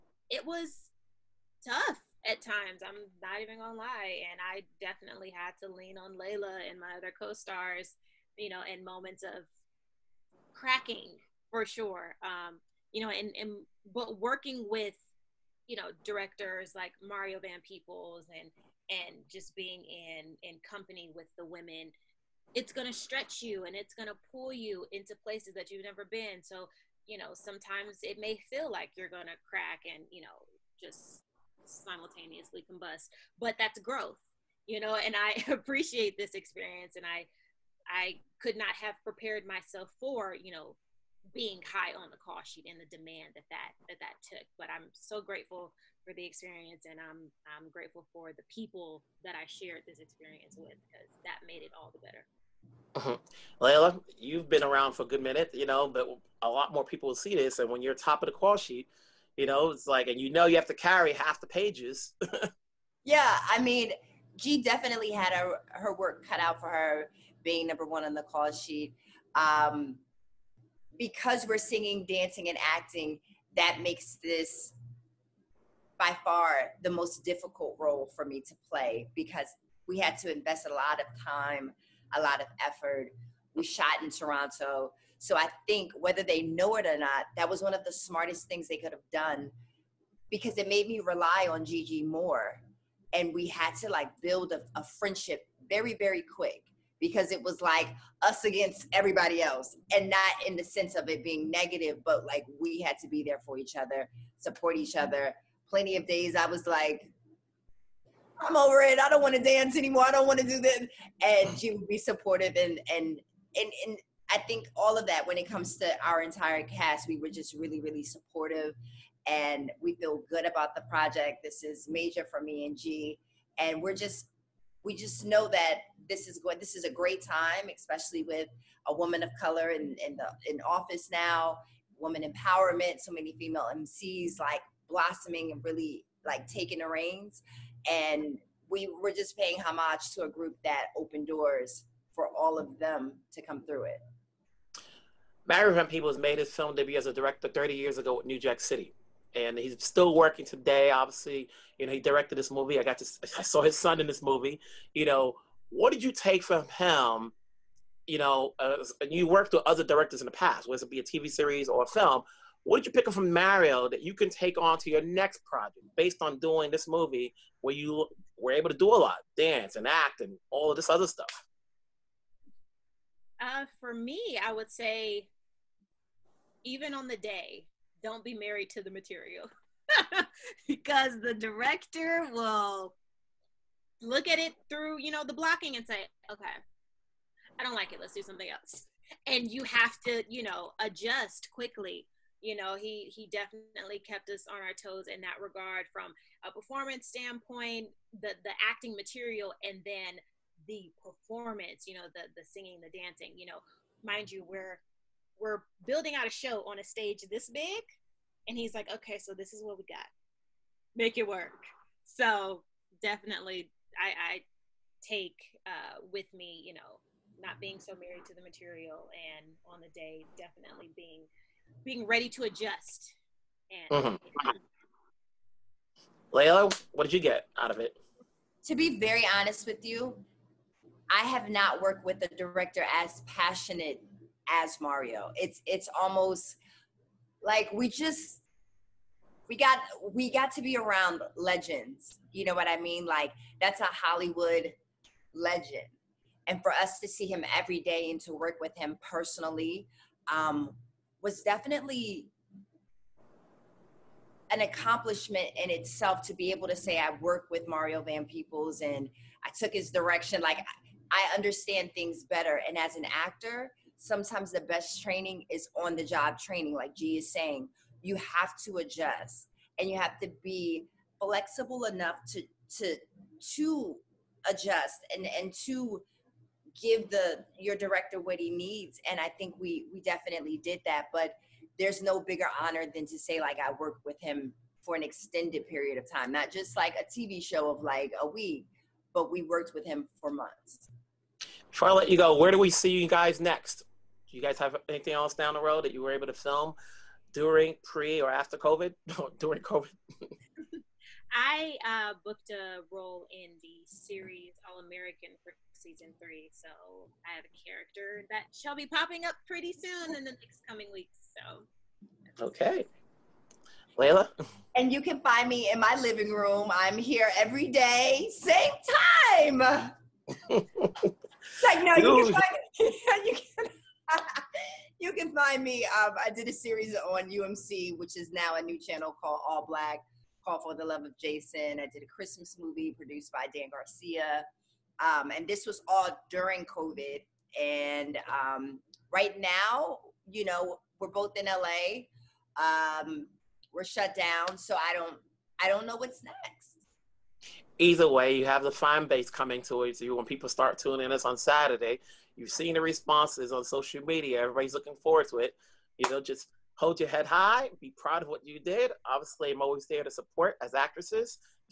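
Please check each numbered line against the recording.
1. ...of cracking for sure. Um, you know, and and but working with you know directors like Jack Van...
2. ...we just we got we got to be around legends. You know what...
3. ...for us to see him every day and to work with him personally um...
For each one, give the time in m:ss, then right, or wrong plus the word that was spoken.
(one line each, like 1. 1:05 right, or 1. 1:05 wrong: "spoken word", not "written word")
1. 0:09 wrong: "Mario", not "Jack"
2. 3:57 right
3. 4:06 right.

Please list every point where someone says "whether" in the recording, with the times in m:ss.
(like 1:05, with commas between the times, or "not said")
1:25, 2:40.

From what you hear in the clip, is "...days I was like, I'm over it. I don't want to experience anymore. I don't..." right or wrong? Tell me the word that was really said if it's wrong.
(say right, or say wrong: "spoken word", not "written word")
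wrong: "dance", not "experience".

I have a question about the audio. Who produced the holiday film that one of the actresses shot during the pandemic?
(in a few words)
Dan Garcia.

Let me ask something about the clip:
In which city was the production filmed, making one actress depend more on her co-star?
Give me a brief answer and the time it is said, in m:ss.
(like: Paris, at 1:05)
Toronto, at 1:24.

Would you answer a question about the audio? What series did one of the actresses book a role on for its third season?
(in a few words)
All American.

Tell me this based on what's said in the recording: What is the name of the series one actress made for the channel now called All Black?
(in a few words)
For the Love of Jason.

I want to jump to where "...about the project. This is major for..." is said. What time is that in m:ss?
2:00.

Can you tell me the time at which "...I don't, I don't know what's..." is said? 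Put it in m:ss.
5:44.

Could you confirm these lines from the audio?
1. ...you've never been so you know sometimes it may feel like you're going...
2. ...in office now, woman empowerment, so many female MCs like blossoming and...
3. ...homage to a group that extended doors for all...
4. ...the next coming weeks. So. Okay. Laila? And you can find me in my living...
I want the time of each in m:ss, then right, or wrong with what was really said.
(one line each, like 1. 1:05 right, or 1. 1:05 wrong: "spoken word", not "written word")
1. 0:25 right
2. 2:10 right
3. 2:19 wrong: "opened", not "extended"
4. 5:10 right.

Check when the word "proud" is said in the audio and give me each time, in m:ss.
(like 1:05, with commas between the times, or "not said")
5:57.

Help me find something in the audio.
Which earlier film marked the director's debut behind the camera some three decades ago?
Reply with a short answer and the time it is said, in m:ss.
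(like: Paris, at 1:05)
New Jack City, at 2:28.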